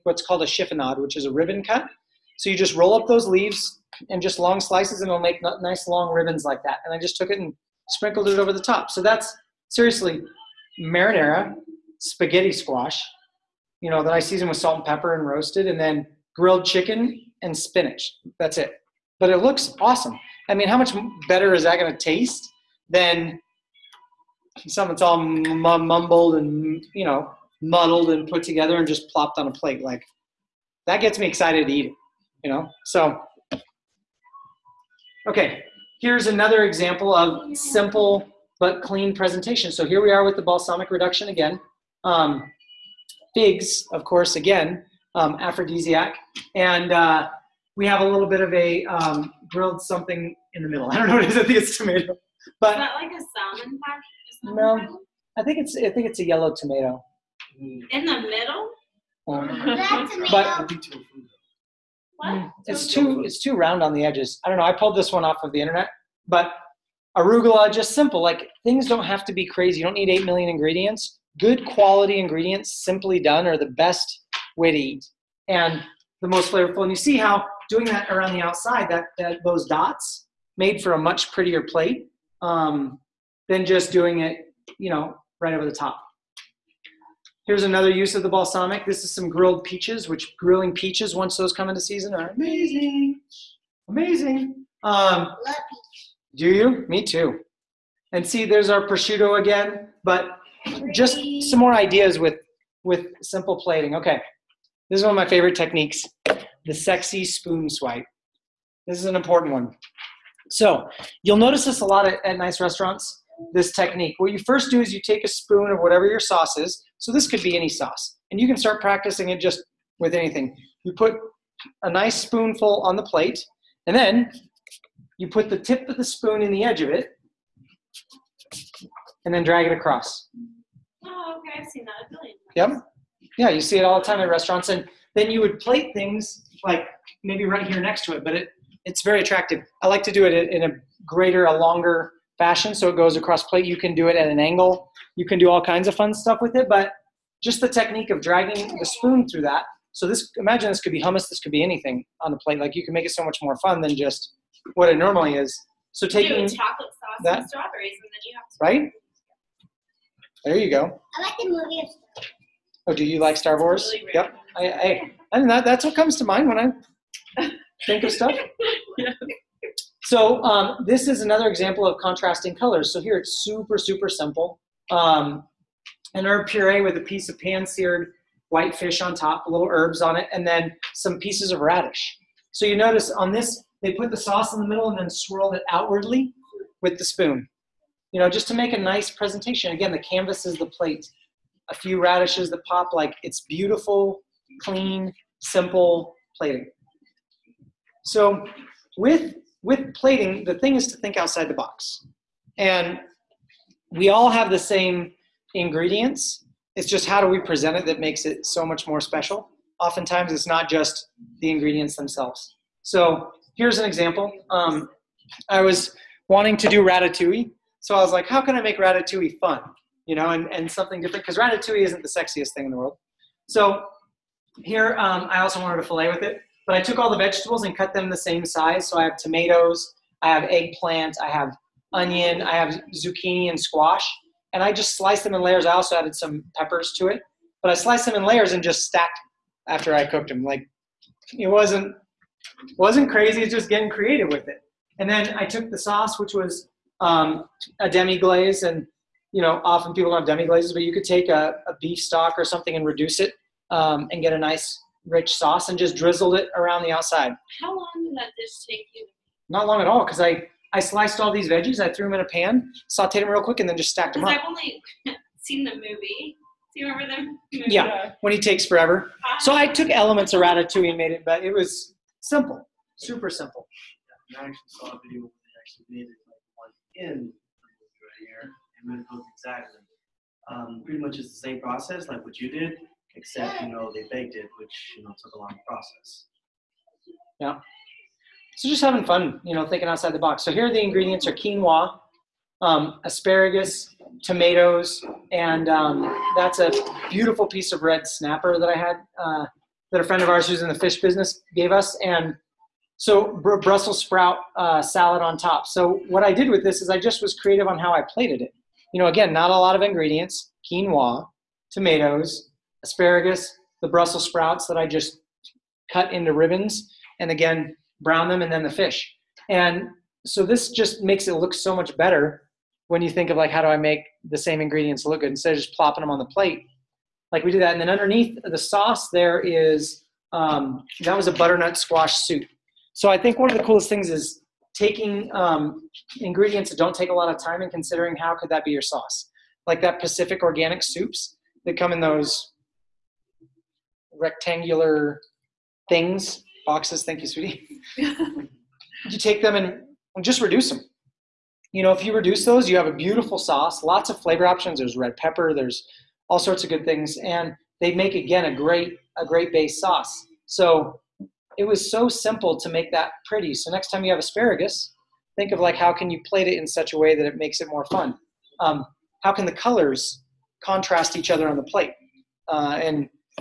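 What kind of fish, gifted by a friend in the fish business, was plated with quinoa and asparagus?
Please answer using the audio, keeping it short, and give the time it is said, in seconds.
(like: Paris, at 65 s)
Red snapper, at 297 s.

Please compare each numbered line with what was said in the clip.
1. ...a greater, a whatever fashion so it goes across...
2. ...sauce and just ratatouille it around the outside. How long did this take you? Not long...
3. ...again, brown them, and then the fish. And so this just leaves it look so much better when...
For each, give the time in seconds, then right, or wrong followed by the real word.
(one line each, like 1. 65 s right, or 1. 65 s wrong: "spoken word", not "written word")
1. 140 s wrong: "longer", not "whatever"
2. 255 s wrong: "drizzle", not "ratatouille"
3. 317 s wrong: "makes", not "leaves".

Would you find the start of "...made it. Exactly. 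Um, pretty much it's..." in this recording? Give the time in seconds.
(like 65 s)
275 s.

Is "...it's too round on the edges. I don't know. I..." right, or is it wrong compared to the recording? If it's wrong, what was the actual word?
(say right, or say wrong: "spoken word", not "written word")
right.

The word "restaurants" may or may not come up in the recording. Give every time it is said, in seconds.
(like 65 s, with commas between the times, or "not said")
112 s, 134 s.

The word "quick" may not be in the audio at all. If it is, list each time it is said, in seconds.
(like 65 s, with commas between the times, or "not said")
263 s.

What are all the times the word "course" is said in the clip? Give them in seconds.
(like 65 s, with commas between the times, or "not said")
44 s.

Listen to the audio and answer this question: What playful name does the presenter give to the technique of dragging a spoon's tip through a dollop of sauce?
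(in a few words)
Sexy spoon swipe.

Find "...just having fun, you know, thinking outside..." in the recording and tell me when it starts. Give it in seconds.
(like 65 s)
288 s.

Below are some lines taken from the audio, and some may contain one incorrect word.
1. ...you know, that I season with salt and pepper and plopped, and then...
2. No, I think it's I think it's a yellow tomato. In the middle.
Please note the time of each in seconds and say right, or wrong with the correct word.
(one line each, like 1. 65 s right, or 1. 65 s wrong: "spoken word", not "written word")
1. 13 s wrong: "roasted", not "plopped"
2. 54 s right.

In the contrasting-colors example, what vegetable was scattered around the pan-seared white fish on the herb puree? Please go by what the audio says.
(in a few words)
Radish.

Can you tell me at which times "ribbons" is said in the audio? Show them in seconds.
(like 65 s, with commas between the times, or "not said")
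1 s, 6 s, 316 s.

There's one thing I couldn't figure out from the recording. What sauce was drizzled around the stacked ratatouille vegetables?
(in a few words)
Demi glaze.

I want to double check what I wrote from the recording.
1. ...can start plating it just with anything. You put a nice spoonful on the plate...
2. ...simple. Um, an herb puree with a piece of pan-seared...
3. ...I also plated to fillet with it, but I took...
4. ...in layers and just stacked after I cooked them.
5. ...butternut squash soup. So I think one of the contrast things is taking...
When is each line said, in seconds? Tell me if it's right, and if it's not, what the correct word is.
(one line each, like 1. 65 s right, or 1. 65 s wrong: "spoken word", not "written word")
1. 118 s wrong: "practicing", not "plating"
2. 174 s right
3. 225 s wrong: "wanted", not "plated"
4. 238 s right
5. 331 s wrong: "coolest", not "contrast".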